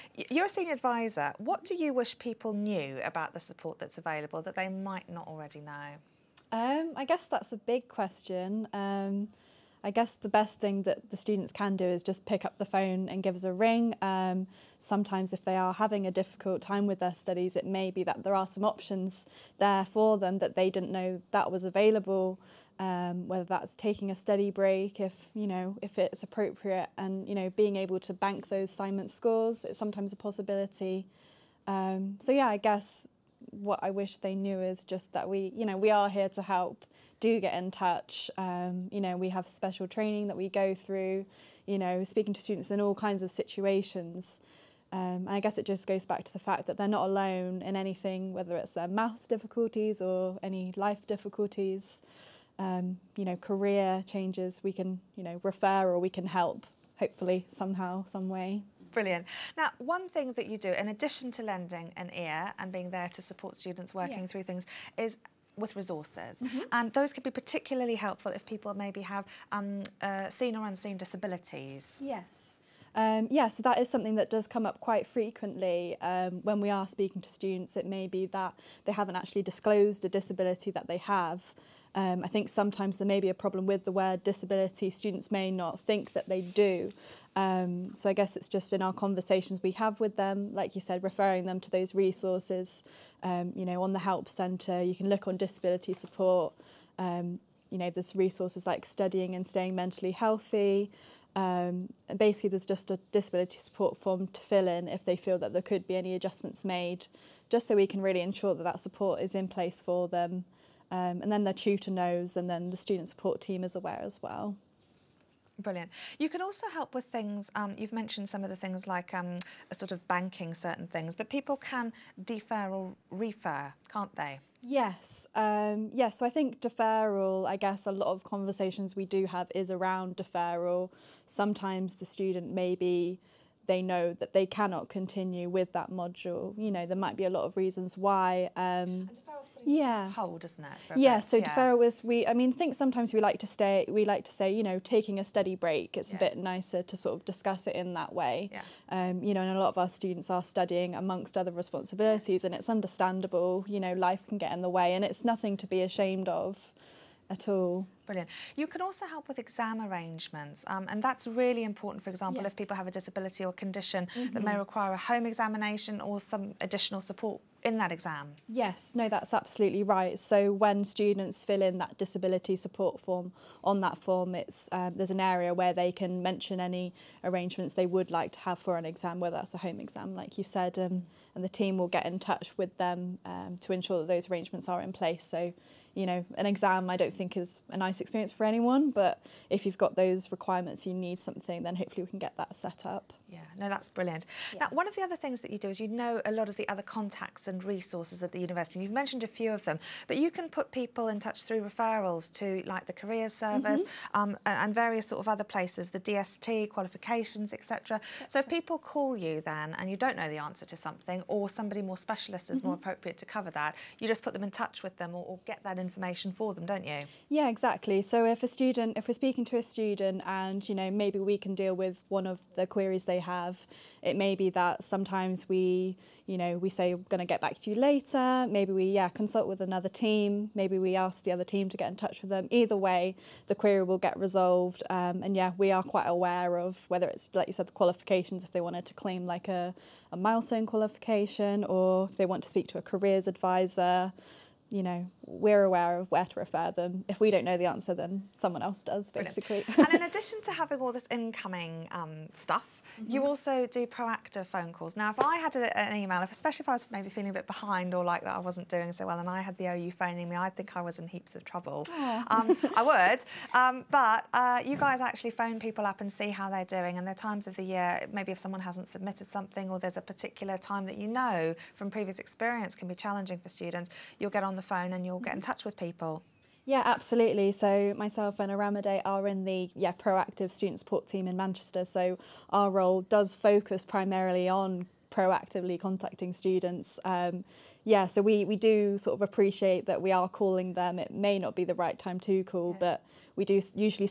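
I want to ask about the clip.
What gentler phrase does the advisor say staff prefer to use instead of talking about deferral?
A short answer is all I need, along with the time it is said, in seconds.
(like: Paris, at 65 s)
taking a study break, at 144 s.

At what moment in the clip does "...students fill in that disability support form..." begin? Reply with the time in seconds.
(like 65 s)
170 s.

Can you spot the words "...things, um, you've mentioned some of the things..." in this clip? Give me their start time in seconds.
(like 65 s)
117 s.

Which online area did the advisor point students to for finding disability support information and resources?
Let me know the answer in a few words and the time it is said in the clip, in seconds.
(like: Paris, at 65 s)
Help Centre, at 93 s.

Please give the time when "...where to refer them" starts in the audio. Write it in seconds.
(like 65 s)
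246 s.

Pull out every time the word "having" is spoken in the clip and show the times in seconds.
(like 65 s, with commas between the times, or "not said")
15 s, 250 s.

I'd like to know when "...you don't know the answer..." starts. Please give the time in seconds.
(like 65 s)
209 s.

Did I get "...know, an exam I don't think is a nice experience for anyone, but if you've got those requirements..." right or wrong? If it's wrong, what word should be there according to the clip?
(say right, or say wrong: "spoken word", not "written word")
right.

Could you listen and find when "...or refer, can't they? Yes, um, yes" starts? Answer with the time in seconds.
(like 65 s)
122 s.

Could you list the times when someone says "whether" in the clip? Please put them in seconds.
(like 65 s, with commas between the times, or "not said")
23 s, 48 s, 179 s, 236 s.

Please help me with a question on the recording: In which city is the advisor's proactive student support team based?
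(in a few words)
Manchester.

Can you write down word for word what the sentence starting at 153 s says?
You know, life can get in the way, and it's nothing to be ashamed of at all.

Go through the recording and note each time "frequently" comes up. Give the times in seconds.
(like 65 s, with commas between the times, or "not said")
75 s.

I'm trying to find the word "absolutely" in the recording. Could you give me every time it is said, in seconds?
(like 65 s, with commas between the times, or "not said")
169 s, 276 s.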